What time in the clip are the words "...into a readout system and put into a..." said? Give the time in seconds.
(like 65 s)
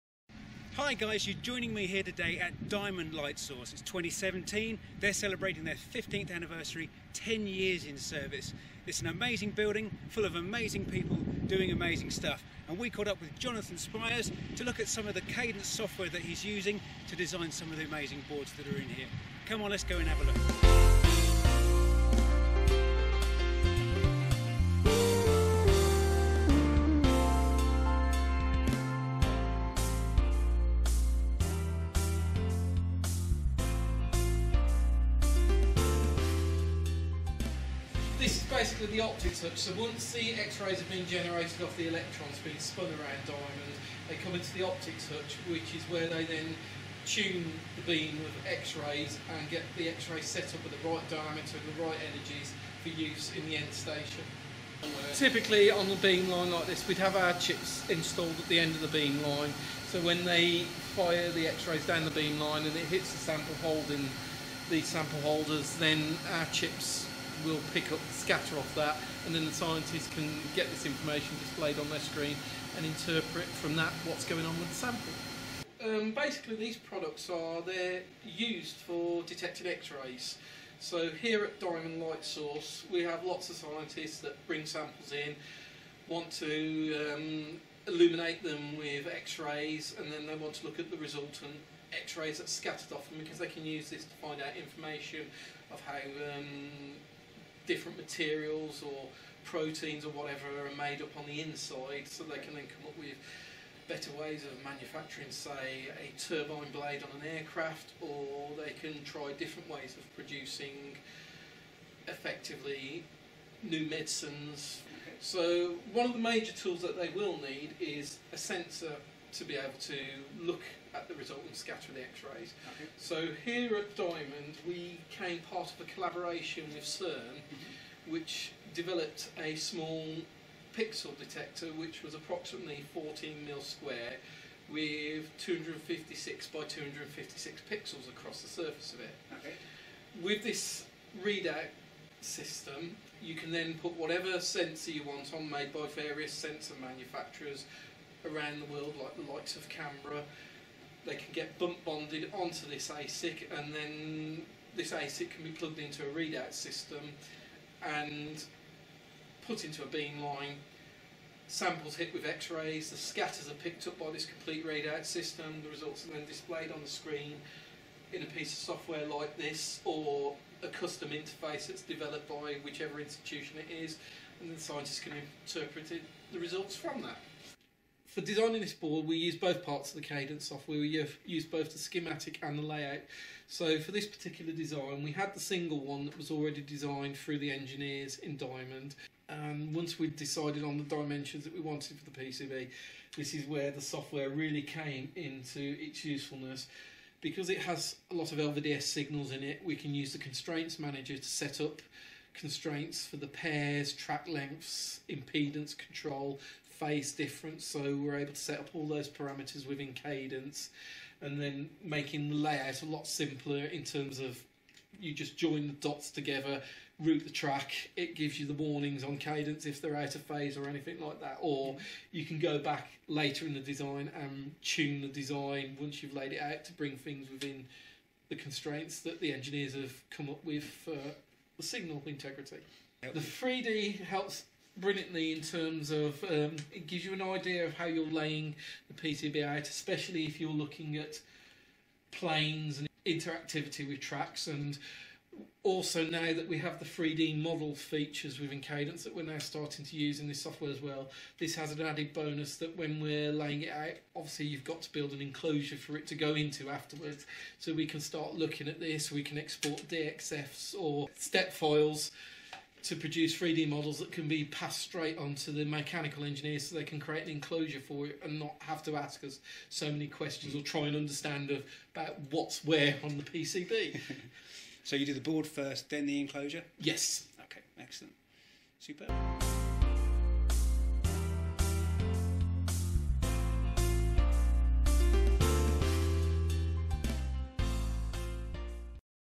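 155 s.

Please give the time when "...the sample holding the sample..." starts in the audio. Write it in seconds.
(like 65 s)
63 s.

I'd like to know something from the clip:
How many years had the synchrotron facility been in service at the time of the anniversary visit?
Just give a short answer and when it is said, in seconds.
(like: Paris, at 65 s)
10, at 7 s.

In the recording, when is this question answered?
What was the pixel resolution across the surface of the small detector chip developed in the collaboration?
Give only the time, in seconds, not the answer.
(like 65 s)
135 s.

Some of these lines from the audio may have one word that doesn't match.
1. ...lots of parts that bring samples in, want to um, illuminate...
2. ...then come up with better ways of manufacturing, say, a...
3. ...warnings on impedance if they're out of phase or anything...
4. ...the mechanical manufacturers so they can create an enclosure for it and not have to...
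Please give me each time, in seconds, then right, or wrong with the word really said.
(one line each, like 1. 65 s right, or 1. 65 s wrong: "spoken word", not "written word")
1. 83 s wrong: "scientists", not "parts"
2. 102 s right
3. 218 s wrong: "cadence", not "impedance"
4. 265 s wrong: "engineers", not "manufacturers".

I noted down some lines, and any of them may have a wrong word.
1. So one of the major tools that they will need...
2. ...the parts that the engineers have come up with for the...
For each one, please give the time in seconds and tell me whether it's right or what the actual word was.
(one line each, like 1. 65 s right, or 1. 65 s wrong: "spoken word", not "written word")
1. 115 s right
2. 228 s wrong: "constraints", not "parts".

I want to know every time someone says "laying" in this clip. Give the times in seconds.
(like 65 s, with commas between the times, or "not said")
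238 s, 253 s.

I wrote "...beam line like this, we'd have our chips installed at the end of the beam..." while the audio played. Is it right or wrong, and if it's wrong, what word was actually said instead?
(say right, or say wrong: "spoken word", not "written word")
right.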